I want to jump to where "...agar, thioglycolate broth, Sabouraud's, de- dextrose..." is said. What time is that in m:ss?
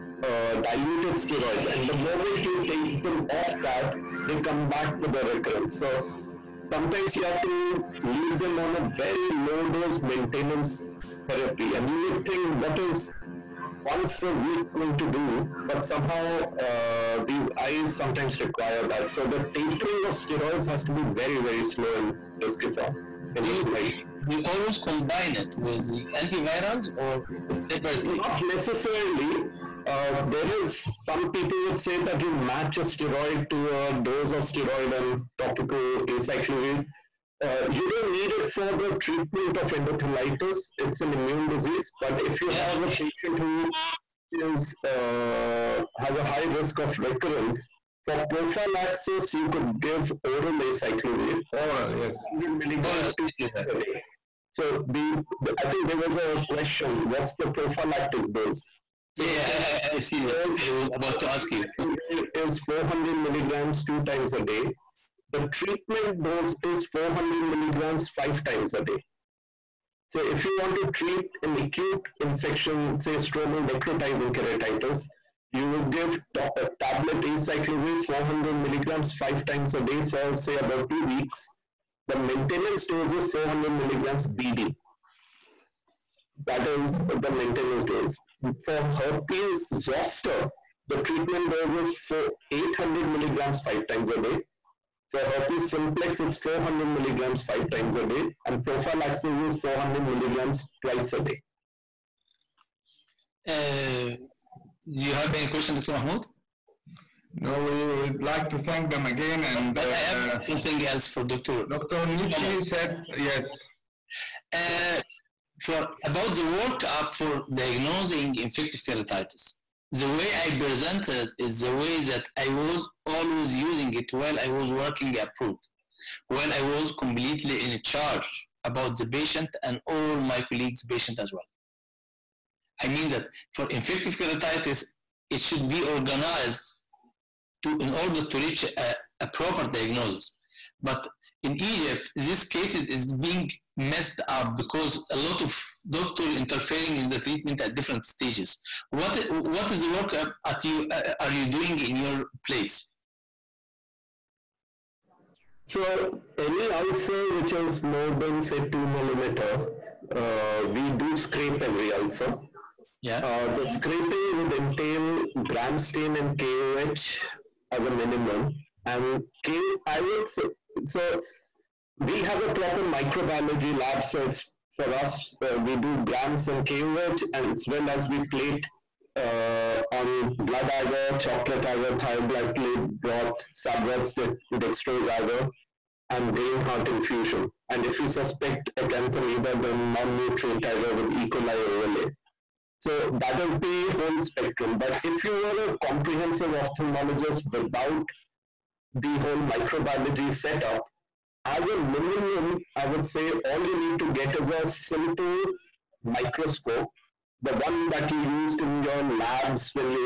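3:01.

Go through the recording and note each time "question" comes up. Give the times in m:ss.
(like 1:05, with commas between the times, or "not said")
0:56, 1:45.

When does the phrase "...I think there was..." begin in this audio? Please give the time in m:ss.
0:55.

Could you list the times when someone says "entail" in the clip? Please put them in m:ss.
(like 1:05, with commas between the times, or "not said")
2:44.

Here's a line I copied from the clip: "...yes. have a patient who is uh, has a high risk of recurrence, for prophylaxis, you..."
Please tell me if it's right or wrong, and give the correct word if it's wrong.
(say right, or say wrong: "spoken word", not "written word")
right.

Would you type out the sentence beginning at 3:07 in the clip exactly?
And if we suspect acanthamoeba, then non nutrient agar with E.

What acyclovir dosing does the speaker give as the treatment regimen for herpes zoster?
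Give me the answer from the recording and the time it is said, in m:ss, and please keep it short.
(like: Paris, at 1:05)
800 milligrams five times a day, at 1:32.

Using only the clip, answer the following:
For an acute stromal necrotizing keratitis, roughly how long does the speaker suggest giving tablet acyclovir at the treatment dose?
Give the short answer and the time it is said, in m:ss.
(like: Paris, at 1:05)
about two weeks, at 1:20.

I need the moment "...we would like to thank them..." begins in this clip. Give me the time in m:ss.
1:47.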